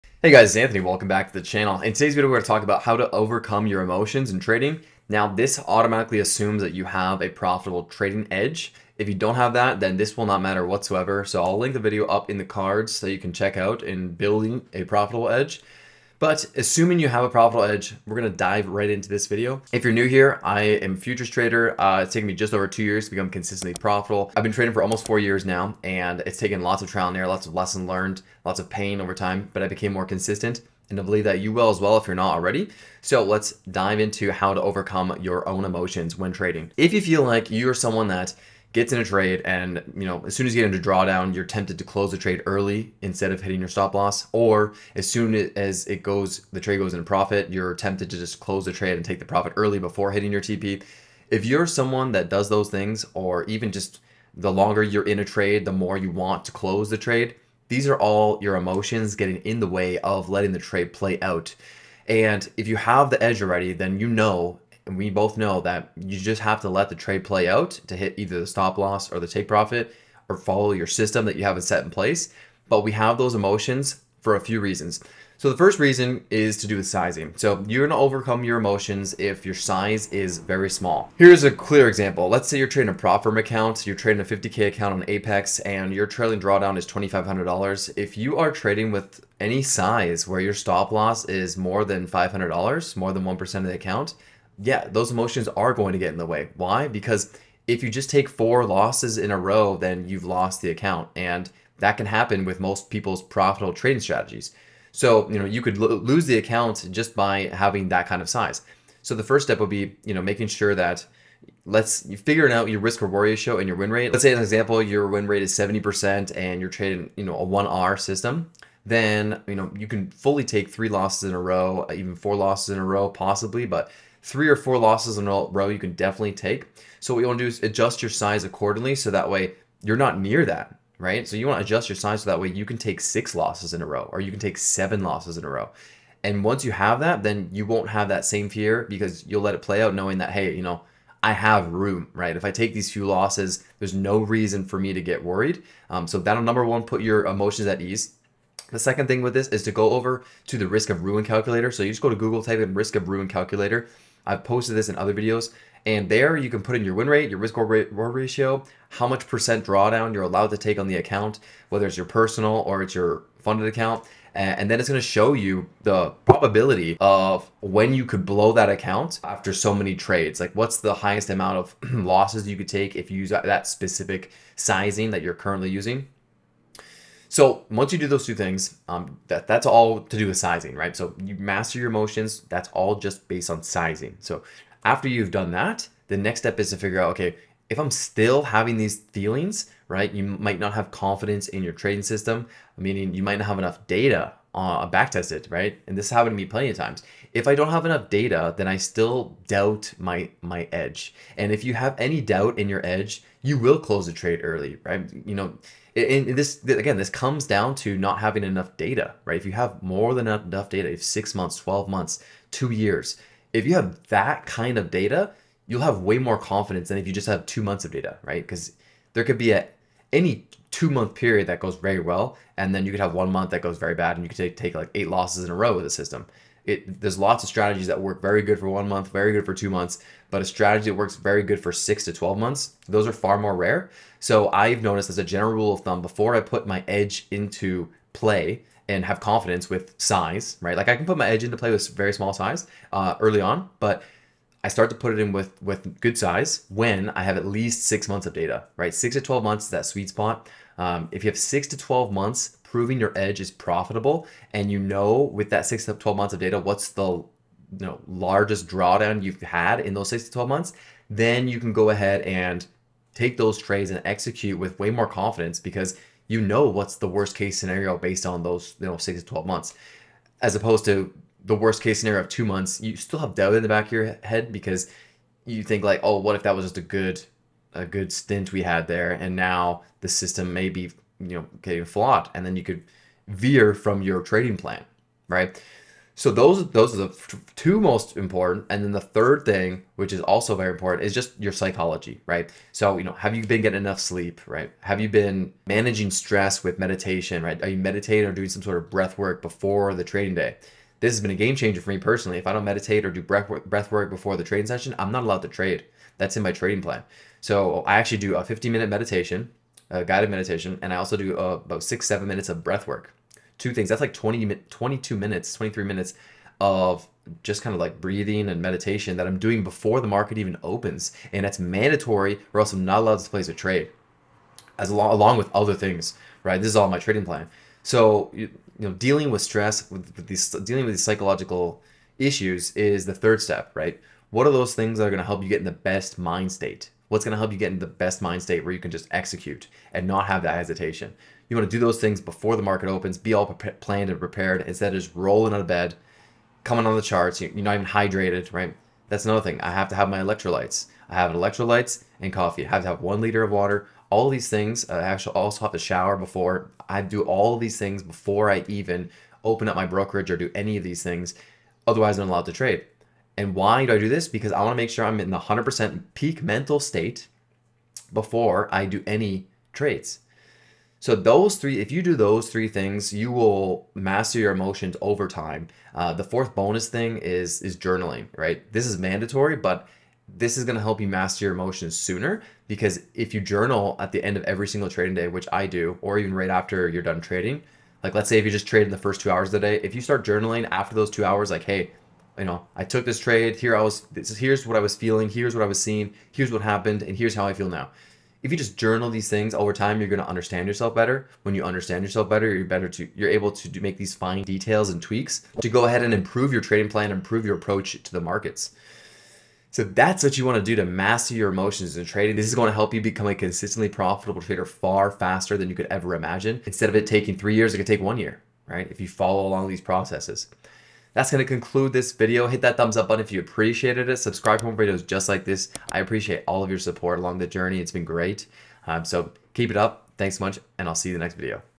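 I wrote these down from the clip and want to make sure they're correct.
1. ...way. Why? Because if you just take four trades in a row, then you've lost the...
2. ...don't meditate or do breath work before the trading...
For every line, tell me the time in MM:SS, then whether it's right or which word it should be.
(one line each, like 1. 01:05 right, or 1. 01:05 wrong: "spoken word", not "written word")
1. 01:36 wrong: "losses", not "trades"
2. 05:02 right.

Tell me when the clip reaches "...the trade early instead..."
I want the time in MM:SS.
00:42.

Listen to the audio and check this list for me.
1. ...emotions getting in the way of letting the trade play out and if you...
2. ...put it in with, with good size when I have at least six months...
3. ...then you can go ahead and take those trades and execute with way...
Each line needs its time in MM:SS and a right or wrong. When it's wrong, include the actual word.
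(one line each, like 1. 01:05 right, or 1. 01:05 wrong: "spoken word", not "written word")
1. 00:58 right
2. 04:04 right
3. 04:21 right.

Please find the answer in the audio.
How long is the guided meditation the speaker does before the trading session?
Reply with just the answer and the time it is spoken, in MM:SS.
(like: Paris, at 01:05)
15 minutes, at 05:08.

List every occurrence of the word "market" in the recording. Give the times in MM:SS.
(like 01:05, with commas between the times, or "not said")
05:20, 05:42, 06:48.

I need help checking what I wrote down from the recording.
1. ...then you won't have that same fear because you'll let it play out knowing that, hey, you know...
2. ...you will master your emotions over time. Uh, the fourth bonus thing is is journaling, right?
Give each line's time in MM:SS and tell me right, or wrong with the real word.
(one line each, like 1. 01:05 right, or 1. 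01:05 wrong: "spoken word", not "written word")
1. 02:17 right
2. 06:13 right.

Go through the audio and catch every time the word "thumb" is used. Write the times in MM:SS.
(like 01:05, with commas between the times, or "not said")
03:55, 07:02.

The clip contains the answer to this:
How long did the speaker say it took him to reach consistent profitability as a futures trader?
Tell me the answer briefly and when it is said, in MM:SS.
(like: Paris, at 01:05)
just over 2 years, at 00:22.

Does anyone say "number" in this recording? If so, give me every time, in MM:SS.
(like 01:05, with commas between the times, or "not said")
02:26.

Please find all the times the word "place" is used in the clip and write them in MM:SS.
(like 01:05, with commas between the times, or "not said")
01:11, 05:23.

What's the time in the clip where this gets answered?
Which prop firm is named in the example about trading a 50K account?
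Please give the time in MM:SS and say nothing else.
01:25.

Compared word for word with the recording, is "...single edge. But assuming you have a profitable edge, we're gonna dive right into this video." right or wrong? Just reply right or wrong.
wrong.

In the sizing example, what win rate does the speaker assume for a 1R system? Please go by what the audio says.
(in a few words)
70%.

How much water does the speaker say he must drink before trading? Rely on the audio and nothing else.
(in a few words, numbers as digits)
1 liter.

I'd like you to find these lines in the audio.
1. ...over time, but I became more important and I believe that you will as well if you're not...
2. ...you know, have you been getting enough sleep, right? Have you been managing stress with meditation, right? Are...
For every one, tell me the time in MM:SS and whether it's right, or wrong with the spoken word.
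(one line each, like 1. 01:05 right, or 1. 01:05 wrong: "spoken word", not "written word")
1. 00:29 wrong: "consistent", not "important"
2. 04:52 right.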